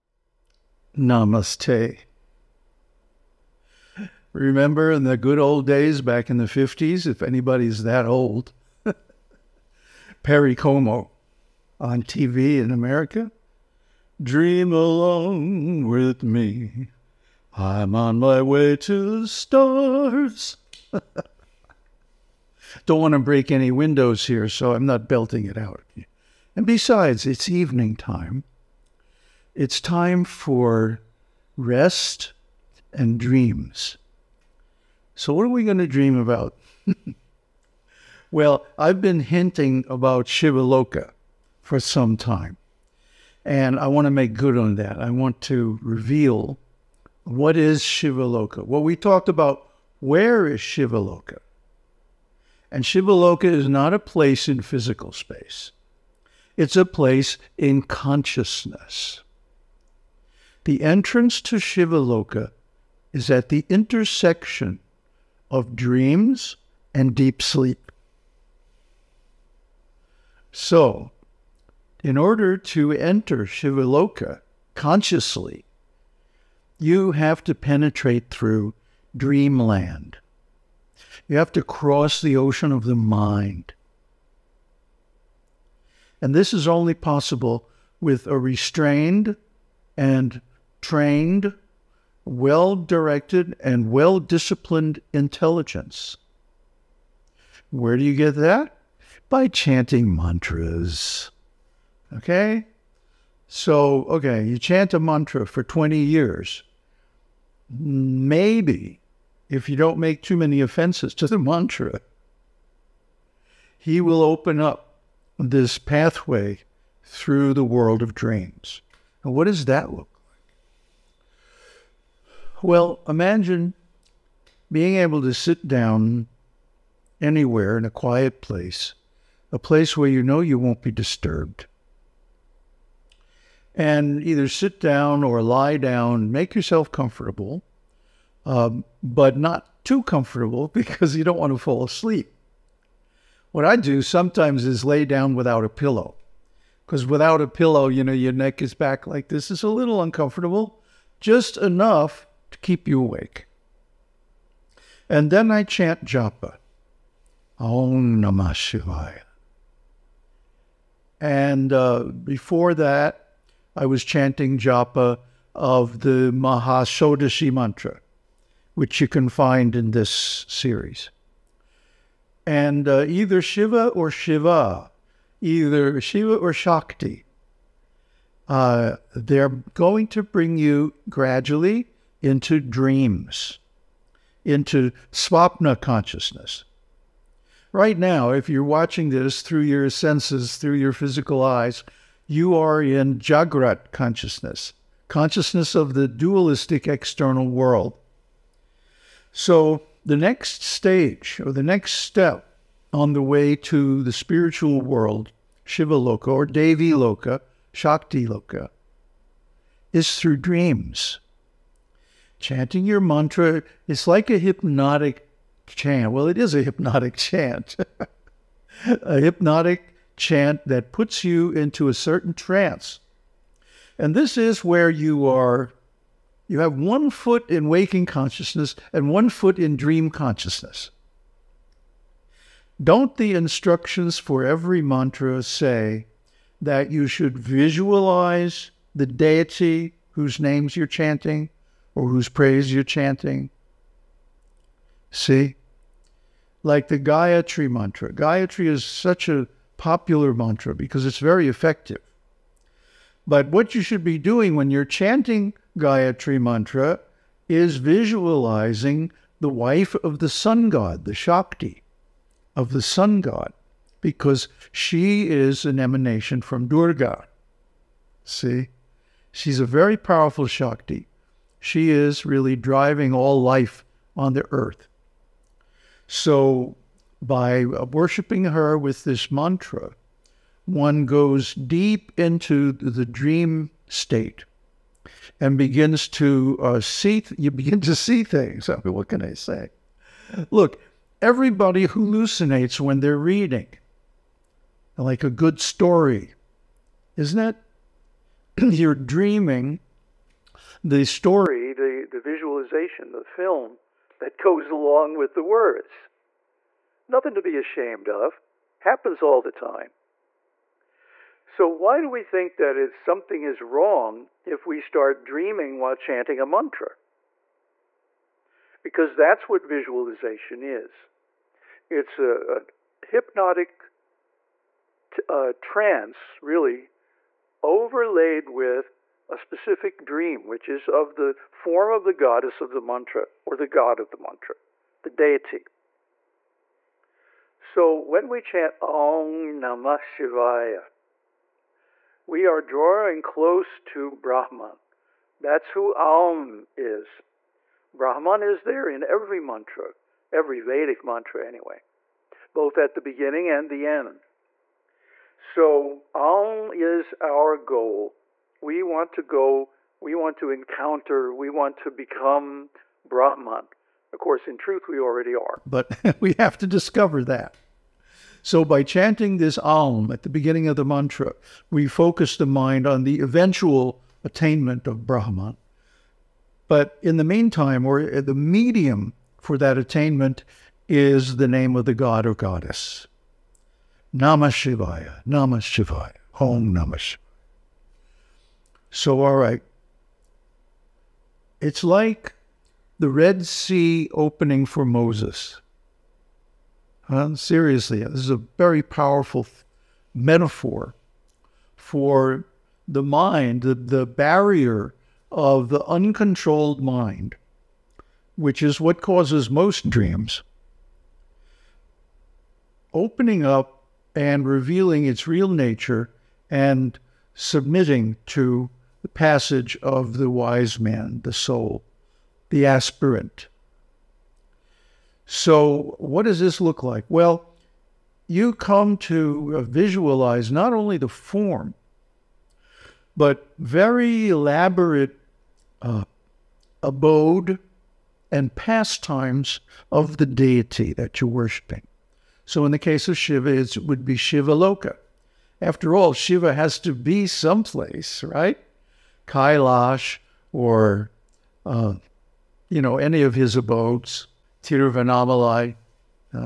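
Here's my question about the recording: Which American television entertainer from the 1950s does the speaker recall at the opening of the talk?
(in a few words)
Perry Como.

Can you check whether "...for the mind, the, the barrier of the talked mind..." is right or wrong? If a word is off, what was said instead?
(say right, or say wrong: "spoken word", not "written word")
wrong: "uncontrolled", not "talked".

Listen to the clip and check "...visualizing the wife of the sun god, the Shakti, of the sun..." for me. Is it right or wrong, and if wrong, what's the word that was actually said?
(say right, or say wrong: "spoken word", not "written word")
right.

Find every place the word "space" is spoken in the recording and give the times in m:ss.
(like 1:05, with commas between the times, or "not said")
0:55.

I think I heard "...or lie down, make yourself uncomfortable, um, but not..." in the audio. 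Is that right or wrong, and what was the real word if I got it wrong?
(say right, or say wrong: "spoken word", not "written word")
wrong: "comfortable", not "uncomfortable".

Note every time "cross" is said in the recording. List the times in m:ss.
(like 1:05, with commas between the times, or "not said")
1:21.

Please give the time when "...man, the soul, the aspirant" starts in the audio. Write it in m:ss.
7:00.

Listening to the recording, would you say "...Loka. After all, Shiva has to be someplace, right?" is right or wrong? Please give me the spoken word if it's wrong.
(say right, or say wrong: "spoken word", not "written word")
right.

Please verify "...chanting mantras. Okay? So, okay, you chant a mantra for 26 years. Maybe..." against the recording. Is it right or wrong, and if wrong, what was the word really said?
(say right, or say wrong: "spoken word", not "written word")
wrong: "20", not "26".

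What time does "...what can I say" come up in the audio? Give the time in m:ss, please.
4:48.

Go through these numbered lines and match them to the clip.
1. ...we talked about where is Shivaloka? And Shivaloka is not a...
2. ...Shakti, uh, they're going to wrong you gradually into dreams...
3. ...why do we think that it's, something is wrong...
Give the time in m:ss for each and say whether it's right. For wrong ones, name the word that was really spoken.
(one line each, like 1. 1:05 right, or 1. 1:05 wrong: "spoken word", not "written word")
1. 0:48 right
2. 2:56 wrong: "bring", not "wrong"
3. 5:11 right.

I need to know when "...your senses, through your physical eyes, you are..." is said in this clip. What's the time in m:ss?
3:09.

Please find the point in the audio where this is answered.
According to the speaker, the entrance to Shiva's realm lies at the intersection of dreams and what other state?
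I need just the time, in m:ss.
1:07.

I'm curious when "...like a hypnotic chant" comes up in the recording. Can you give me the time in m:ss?
3:34.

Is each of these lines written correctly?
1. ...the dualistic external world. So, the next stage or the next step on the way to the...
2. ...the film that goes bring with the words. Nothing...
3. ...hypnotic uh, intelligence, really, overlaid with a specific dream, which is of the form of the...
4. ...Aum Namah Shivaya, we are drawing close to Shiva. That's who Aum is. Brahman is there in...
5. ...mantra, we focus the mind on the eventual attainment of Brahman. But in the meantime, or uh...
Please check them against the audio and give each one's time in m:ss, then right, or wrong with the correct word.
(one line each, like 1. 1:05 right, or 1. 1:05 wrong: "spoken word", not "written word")
1. 3:15 right
2. 5:03 wrong: "along", not "bring"
3. 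5:23 wrong: "trance", not "intelligence"
4. 5:38 wrong: "Brahman", not "Shiva"
5. 6:10 right.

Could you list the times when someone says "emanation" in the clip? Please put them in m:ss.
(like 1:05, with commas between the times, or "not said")
4:25.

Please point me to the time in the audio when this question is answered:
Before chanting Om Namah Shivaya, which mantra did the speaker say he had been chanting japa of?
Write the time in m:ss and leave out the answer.
2:46.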